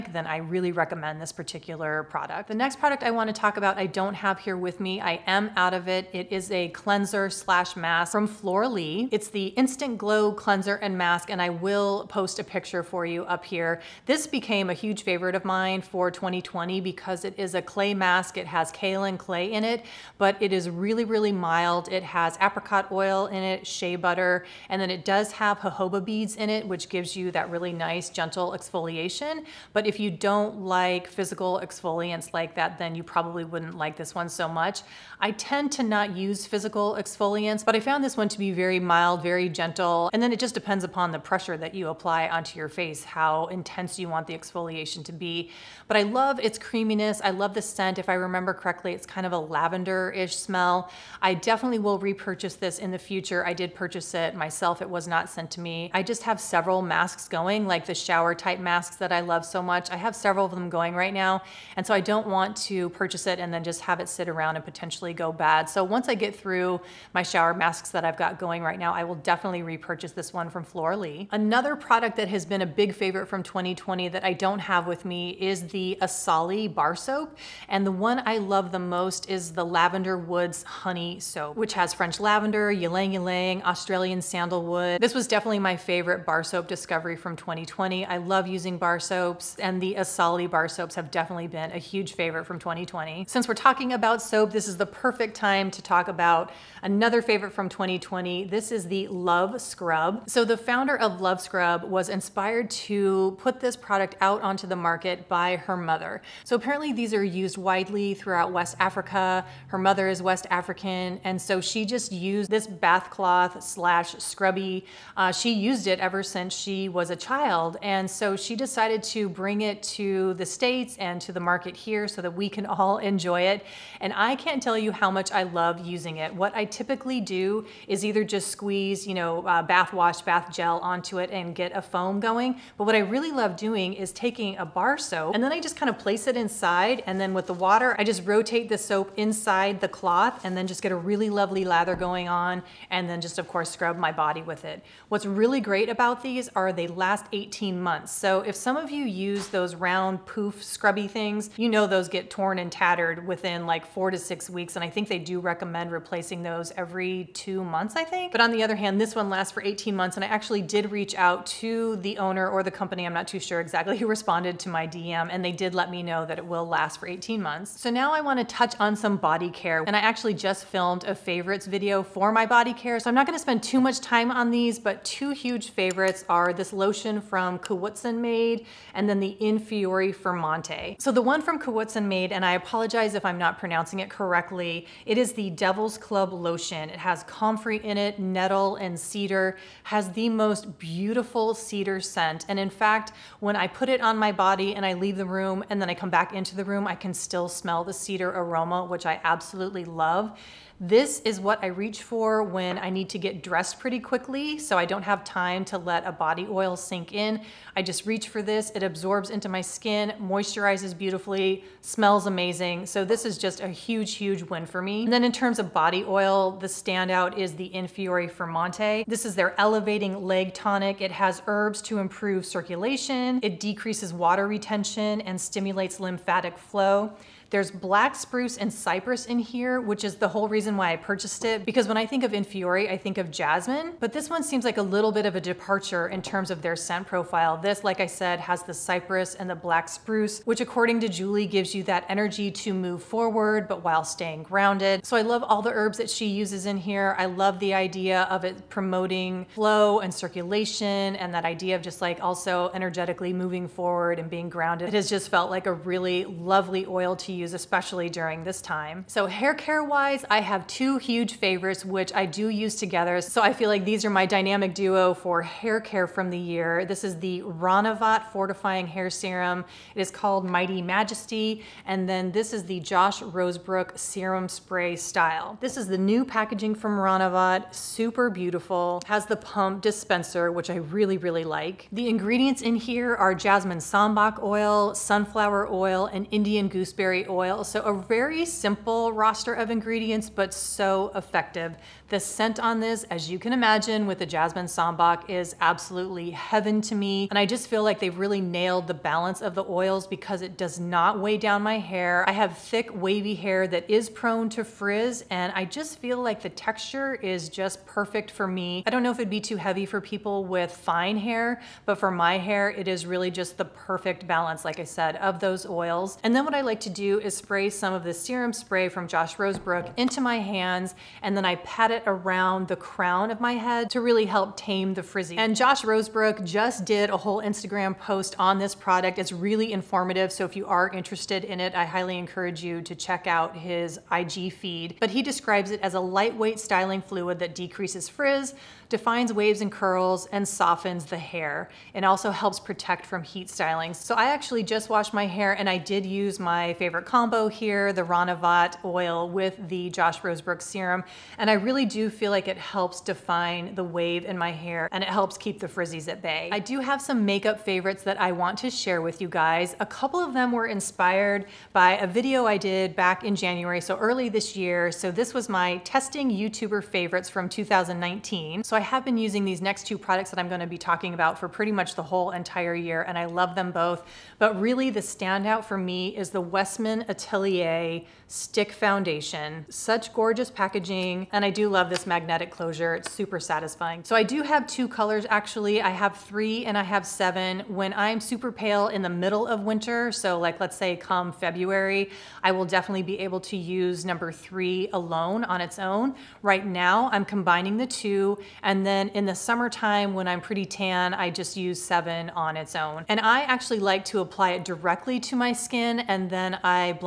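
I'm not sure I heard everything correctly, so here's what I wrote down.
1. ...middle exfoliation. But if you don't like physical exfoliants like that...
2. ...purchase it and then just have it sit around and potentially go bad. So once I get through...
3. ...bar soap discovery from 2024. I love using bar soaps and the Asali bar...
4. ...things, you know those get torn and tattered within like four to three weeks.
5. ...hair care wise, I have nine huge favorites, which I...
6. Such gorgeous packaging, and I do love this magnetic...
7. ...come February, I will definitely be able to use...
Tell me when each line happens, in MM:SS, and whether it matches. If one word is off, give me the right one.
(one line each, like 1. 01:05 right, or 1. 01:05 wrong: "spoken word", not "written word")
1. 00:28 wrong: "gentle", not "middle"
2. 01:02 right
3. 01:26 wrong: "2020", not "2024"
4. 02:31 wrong: "six", not "three"
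5. 04:19 wrong: "two", not "nine"
6. 06:19 right
7. 06:30 right.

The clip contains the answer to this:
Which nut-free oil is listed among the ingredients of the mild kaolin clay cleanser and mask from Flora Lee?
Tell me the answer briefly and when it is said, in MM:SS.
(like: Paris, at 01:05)
apricot oil, at 00:22.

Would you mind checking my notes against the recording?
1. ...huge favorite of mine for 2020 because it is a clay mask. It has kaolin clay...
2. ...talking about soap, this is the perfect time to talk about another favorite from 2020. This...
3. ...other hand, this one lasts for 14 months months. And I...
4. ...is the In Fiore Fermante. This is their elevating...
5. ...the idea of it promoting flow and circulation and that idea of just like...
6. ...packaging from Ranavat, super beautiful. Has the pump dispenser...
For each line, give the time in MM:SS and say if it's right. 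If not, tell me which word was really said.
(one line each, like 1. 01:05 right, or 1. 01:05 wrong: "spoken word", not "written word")
1. 00:14 right
2. 01:33 right
3. 02:38 wrong: "18", not "14"
4. 03:37 right
5. 04:07 right
6. 04:36 right.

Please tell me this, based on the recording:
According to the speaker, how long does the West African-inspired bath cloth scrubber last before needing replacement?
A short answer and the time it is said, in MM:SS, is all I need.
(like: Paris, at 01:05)
18 months, at 02:26.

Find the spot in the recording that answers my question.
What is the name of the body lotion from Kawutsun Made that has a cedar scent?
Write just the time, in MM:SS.
03:05.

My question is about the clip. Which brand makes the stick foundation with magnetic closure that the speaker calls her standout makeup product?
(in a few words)
Westman Atelier.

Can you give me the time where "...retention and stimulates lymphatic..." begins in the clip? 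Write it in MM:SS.
03:44.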